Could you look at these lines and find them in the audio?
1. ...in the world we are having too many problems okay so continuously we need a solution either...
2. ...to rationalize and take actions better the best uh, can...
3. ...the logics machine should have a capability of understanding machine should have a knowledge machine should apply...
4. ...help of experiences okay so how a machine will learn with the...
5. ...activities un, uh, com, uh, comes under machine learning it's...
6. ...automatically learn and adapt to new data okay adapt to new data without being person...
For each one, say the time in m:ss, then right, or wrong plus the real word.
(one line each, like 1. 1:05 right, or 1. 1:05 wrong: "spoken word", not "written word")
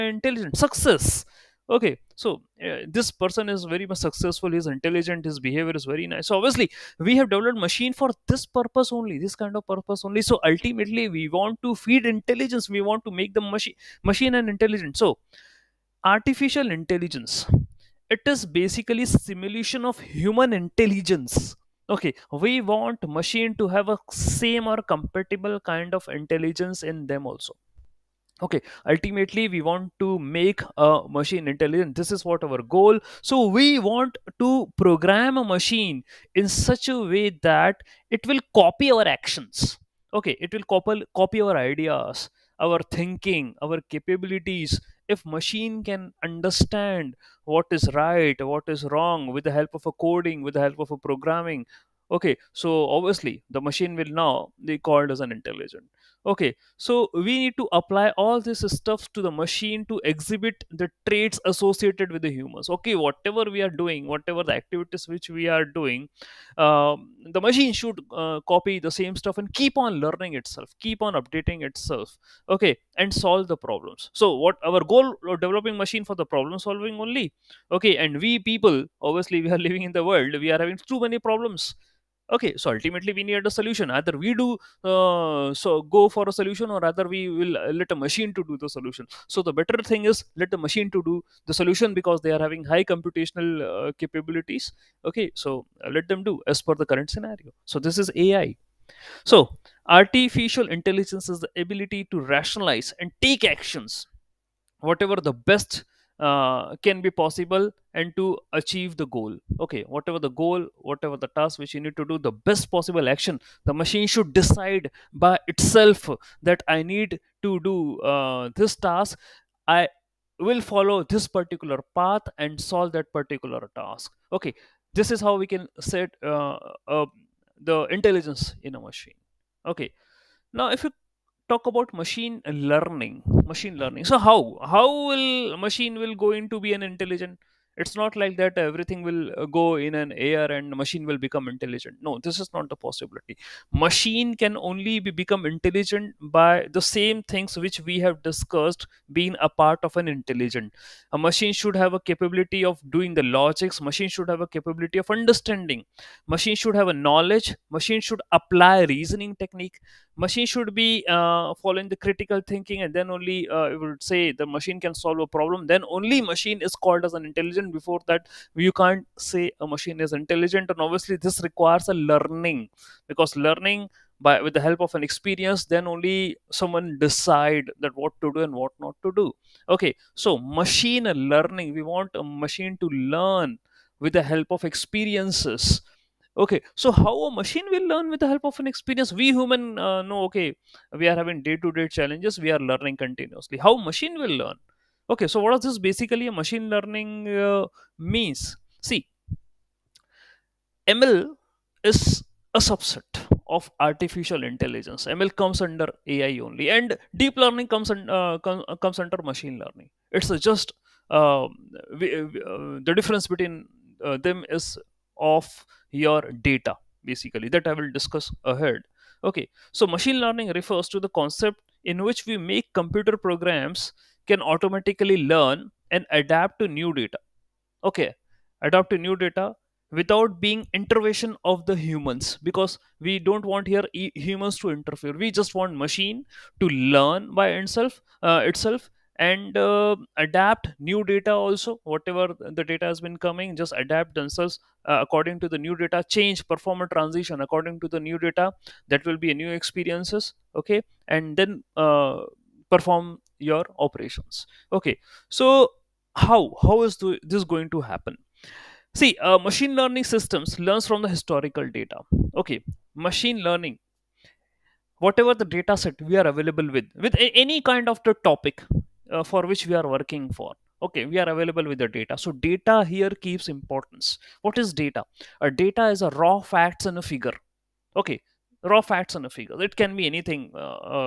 1. 1:19 wrong: "ultimately", not "continuously"
2. 1:42 wrong: "whatever", not "better"
3. 2:33 right
4. 3:04 right
5. 3:27 wrong: "comes", not "activities"
6. 3:44 wrong: "intervention", not "person".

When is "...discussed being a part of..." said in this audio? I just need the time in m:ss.
2:28.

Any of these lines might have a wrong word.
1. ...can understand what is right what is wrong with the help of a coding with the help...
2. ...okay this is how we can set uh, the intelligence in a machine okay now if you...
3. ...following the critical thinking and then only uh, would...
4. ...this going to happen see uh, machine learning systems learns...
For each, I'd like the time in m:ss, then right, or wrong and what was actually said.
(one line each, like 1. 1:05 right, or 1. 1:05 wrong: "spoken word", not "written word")
1. 0:45 right
2. 2:04 right
3. 2:41 right
4. 4:17 right.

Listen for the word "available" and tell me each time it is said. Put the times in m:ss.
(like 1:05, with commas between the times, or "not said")
4:26, 4:31.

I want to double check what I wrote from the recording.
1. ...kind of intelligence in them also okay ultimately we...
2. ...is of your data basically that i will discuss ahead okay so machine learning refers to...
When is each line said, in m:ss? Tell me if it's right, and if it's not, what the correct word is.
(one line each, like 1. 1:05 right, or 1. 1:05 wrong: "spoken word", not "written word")
1. 0:25 right
2. 3:34 right.